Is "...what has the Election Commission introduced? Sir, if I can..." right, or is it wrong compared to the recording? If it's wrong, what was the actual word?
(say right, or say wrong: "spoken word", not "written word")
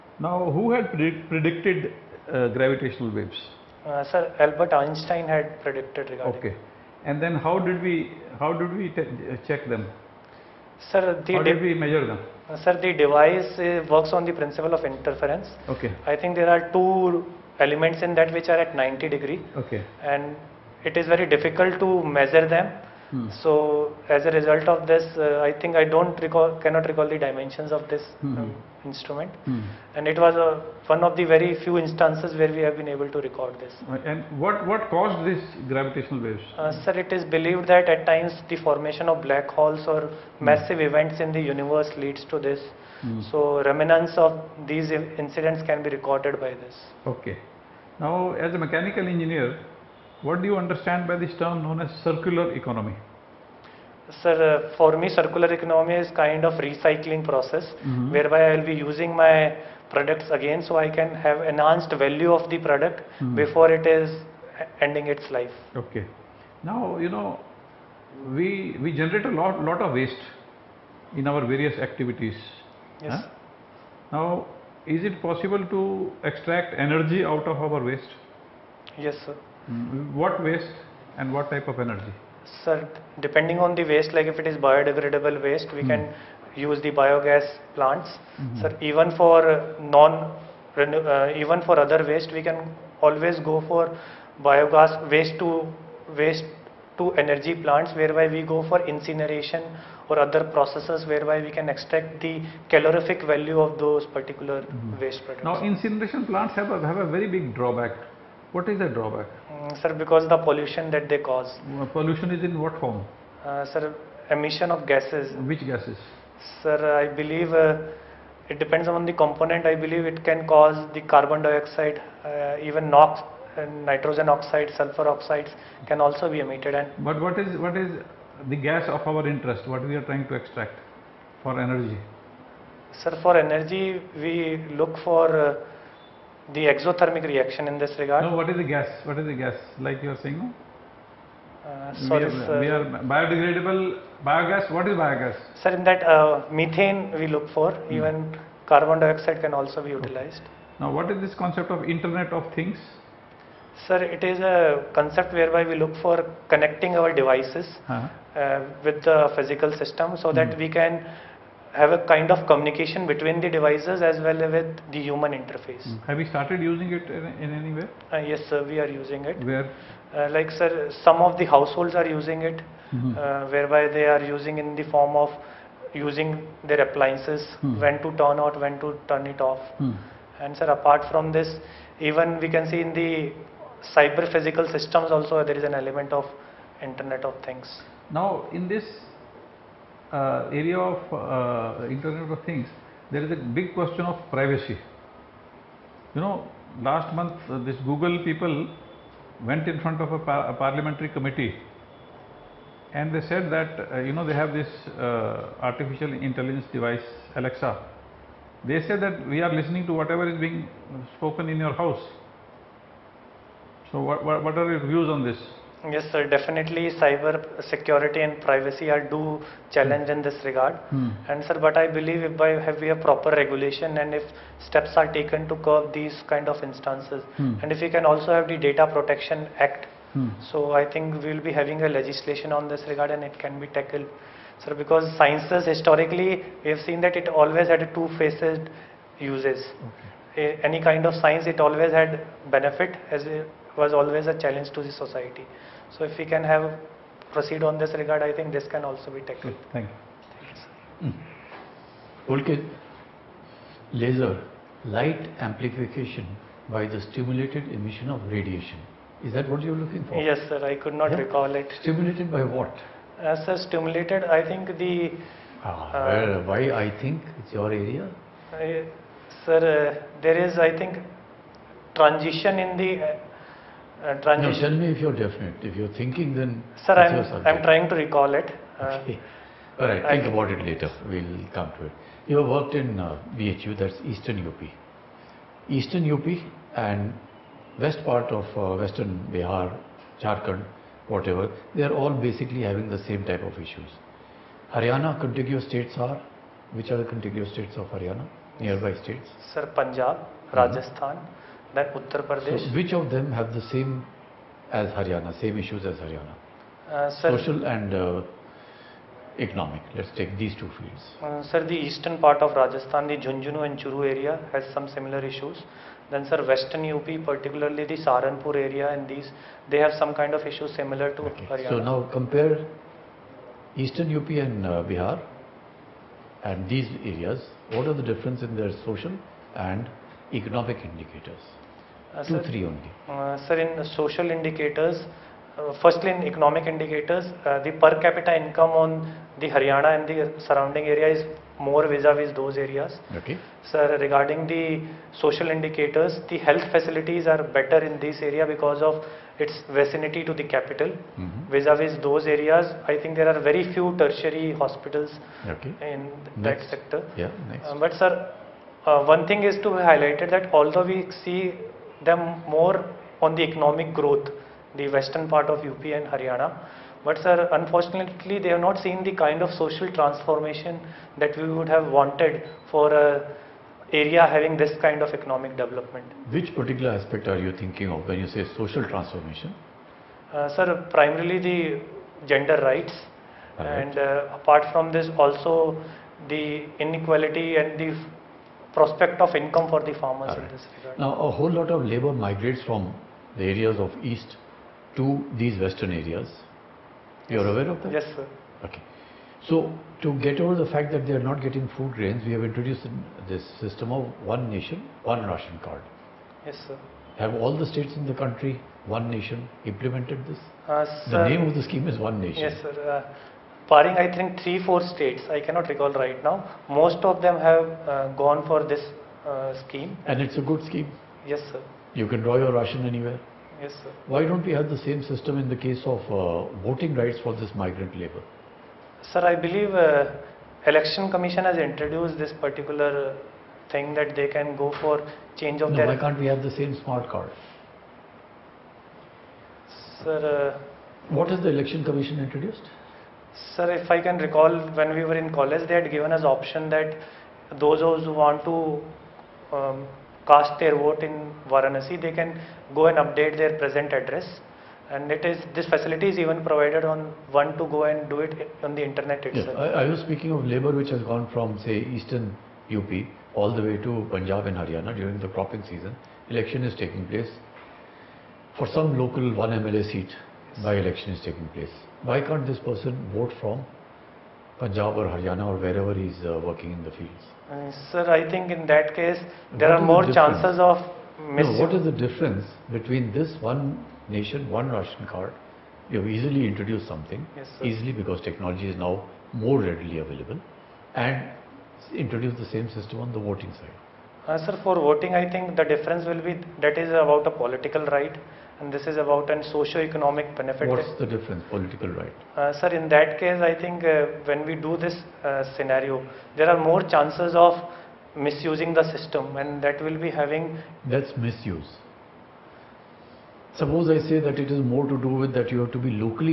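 right.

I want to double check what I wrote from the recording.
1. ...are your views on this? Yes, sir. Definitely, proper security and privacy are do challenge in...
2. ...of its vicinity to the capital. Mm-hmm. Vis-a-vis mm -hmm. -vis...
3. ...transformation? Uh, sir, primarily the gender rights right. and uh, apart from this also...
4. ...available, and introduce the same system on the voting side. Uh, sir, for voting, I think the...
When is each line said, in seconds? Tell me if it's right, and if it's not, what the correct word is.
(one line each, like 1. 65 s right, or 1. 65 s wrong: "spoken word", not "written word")
1. 214 s wrong: "cyber", not "proper"
2. 348 s right
3. 378 s right
4. 489 s right.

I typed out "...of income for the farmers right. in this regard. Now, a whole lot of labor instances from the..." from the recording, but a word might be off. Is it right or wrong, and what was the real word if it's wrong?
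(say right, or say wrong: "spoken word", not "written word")
wrong: "migrates", not "instances".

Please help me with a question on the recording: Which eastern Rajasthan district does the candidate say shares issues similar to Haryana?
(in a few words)
Jhunjhunu.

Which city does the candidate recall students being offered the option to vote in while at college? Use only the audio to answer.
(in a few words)
Varanasi.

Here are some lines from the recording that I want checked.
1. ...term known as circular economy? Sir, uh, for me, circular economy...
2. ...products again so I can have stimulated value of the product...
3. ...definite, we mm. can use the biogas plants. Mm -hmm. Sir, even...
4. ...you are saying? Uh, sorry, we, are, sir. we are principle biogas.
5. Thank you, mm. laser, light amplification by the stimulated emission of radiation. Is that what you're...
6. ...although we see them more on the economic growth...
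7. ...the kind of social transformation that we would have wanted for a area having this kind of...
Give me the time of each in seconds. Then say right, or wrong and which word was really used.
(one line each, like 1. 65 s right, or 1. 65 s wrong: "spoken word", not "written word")
1. 51 s right
2. 59 s wrong: "enhanced", not "stimulated"
3. 85 s wrong: "waste", not "definite"
4. 140 s wrong: "biodegradable", not "principle"
5. 252 s right
6. 360 s right
7. 369 s right.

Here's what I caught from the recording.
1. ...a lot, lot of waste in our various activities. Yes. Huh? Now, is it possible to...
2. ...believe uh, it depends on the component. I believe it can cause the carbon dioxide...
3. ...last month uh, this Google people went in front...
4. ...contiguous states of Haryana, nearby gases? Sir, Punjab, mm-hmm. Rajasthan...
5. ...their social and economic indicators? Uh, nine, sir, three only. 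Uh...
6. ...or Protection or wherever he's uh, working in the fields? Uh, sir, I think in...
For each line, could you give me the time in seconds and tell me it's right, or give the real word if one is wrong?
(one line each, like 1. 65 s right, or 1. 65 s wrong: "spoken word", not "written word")
1. 69 s right
2. 117 s right
3. 196 s right
4. 297 s wrong: "states", not "gases"
5. 328 s wrong: "two", not "nine"
6. 474 s wrong: "Haryana", not "Protection".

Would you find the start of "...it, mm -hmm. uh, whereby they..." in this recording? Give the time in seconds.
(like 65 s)
172 s.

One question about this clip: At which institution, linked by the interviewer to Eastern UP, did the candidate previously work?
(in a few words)
BHU.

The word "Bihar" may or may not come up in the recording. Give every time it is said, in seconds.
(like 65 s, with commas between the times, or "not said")
289 s, 324 s.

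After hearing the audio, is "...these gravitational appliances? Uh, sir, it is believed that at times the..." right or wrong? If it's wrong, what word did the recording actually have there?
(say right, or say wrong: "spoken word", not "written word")
wrong: "waves", not "appliances".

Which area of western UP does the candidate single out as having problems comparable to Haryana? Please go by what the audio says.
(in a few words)
Saranpur.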